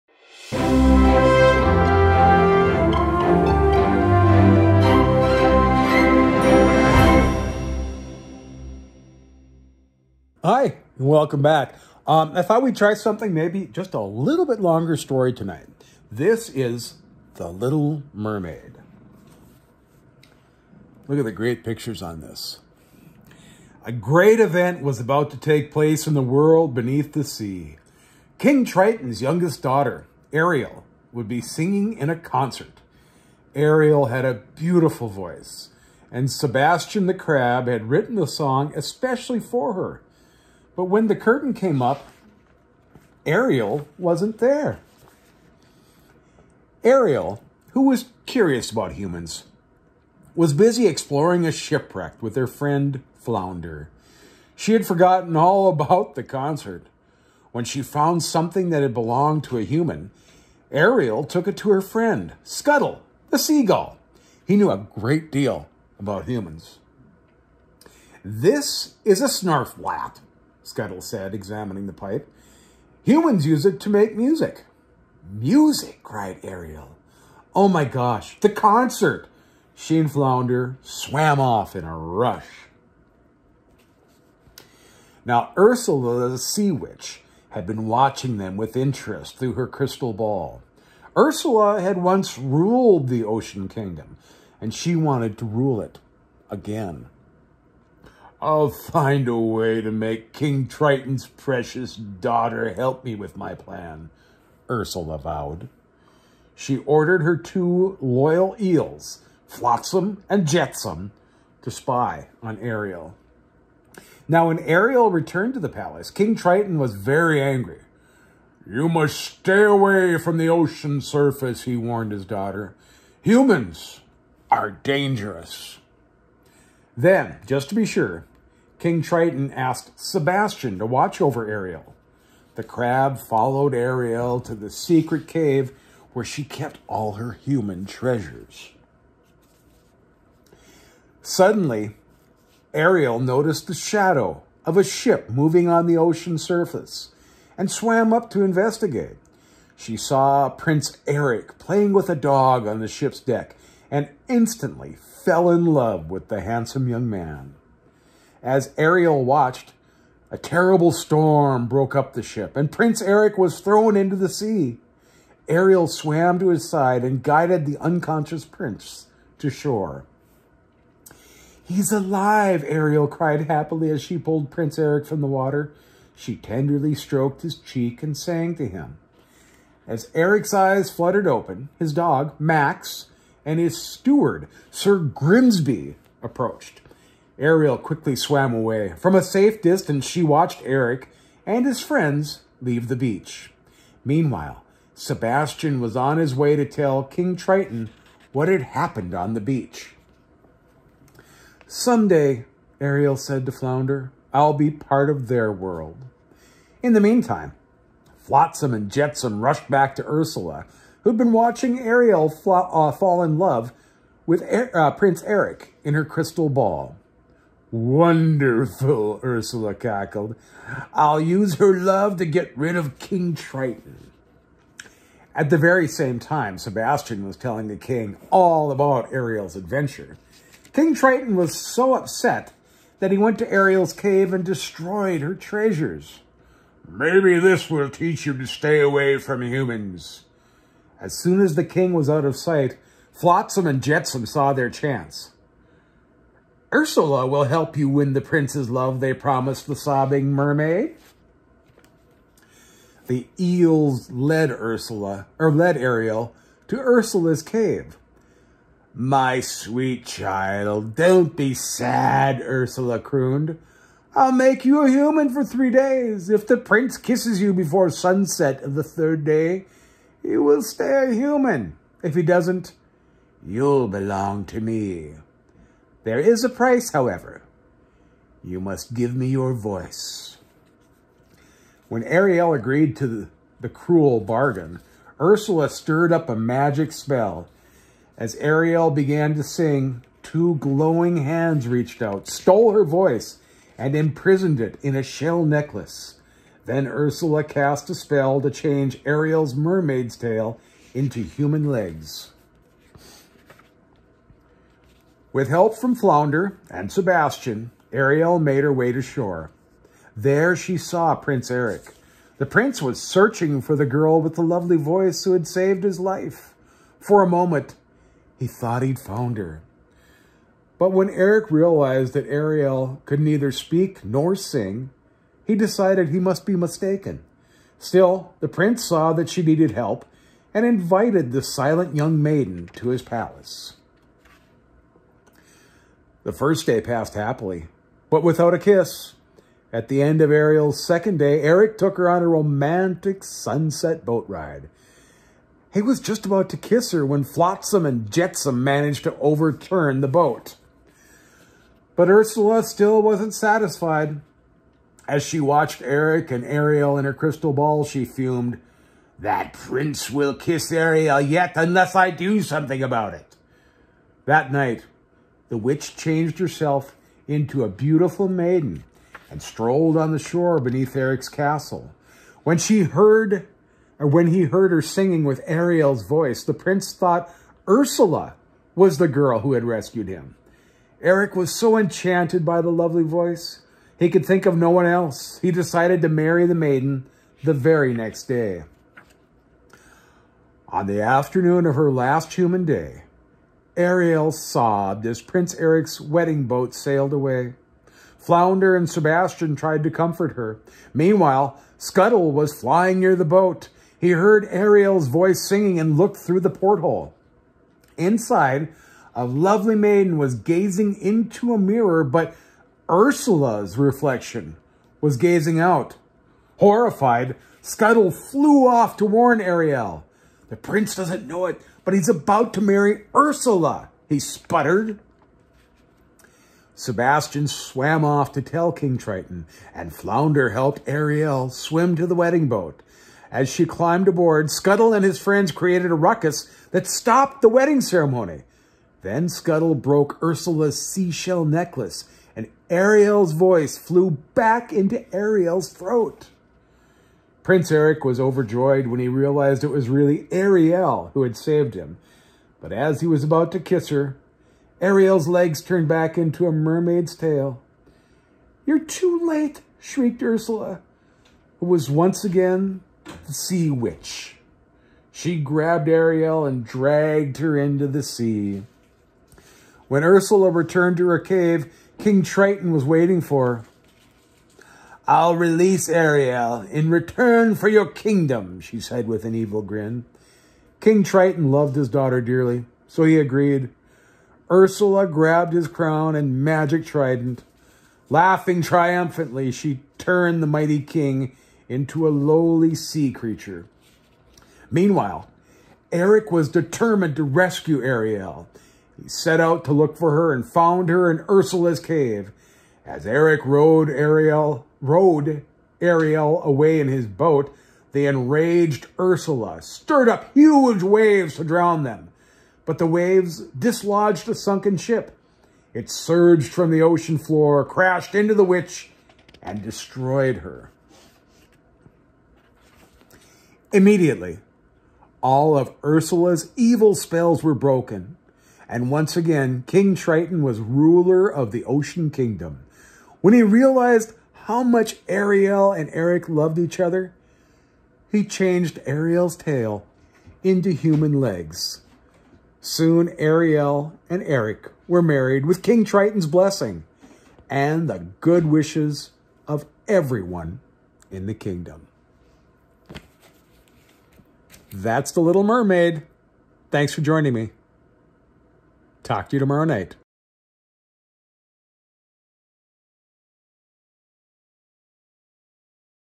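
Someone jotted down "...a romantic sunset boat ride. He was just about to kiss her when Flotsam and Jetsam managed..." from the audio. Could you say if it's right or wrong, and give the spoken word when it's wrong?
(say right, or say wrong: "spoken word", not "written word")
right.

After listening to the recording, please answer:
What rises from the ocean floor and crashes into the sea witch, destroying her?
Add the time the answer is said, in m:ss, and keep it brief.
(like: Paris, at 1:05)
a sunken ship, at 8:34.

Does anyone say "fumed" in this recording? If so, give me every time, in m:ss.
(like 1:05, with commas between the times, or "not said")
5:58.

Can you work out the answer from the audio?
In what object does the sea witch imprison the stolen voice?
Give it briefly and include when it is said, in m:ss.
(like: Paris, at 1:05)
a shell necklace, at 4:55.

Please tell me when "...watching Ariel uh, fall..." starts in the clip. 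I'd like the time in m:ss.
3:31.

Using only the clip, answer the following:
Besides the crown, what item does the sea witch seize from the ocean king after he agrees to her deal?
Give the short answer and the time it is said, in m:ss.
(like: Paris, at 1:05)
magic trident, at 8:06.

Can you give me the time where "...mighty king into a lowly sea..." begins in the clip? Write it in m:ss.
8:10.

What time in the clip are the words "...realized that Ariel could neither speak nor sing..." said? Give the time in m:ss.
5:21.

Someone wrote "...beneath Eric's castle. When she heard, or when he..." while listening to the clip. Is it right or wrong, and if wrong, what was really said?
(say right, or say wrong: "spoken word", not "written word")
right.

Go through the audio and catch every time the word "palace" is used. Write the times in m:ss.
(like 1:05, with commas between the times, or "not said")
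1:55, 5:33.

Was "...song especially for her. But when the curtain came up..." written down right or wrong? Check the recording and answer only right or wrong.
right.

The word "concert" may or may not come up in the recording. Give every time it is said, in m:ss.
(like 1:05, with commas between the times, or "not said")
0:32, 0:56, 1:18.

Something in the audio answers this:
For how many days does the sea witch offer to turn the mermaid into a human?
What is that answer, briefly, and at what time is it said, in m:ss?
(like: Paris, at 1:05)
3, at 4:25.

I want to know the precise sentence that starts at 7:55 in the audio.
I'll release Ariel in return for your kingdom, she said with an evil grin.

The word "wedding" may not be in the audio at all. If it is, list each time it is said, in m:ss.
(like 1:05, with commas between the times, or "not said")
6:36, 7:12, 7:17.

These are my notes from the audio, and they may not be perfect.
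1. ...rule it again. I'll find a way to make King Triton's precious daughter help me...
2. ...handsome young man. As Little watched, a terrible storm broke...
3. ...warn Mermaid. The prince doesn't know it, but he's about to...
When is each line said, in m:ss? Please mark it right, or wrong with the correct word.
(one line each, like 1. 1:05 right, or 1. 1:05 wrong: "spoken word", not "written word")
1. 1:35 right
2. 2:36 wrong: "Ariel", not "Little"
3. 6:59 wrong: "Ariel", not "Mermaid".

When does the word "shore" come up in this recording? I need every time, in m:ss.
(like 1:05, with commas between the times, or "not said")
2:49, 5:09, 6:10.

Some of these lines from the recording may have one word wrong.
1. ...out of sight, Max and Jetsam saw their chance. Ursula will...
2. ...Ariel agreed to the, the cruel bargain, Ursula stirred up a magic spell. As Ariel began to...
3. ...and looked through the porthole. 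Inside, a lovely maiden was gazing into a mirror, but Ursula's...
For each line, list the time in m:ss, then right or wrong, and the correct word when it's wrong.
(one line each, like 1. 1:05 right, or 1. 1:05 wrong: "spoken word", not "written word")
1. 4:02 wrong: "Flotsam", not "Max"
2. 4:42 right
3. 6:45 right.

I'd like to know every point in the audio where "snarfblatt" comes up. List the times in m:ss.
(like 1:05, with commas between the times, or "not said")
1:09.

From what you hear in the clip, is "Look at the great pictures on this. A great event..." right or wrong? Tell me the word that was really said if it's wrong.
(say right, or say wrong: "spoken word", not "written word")
right.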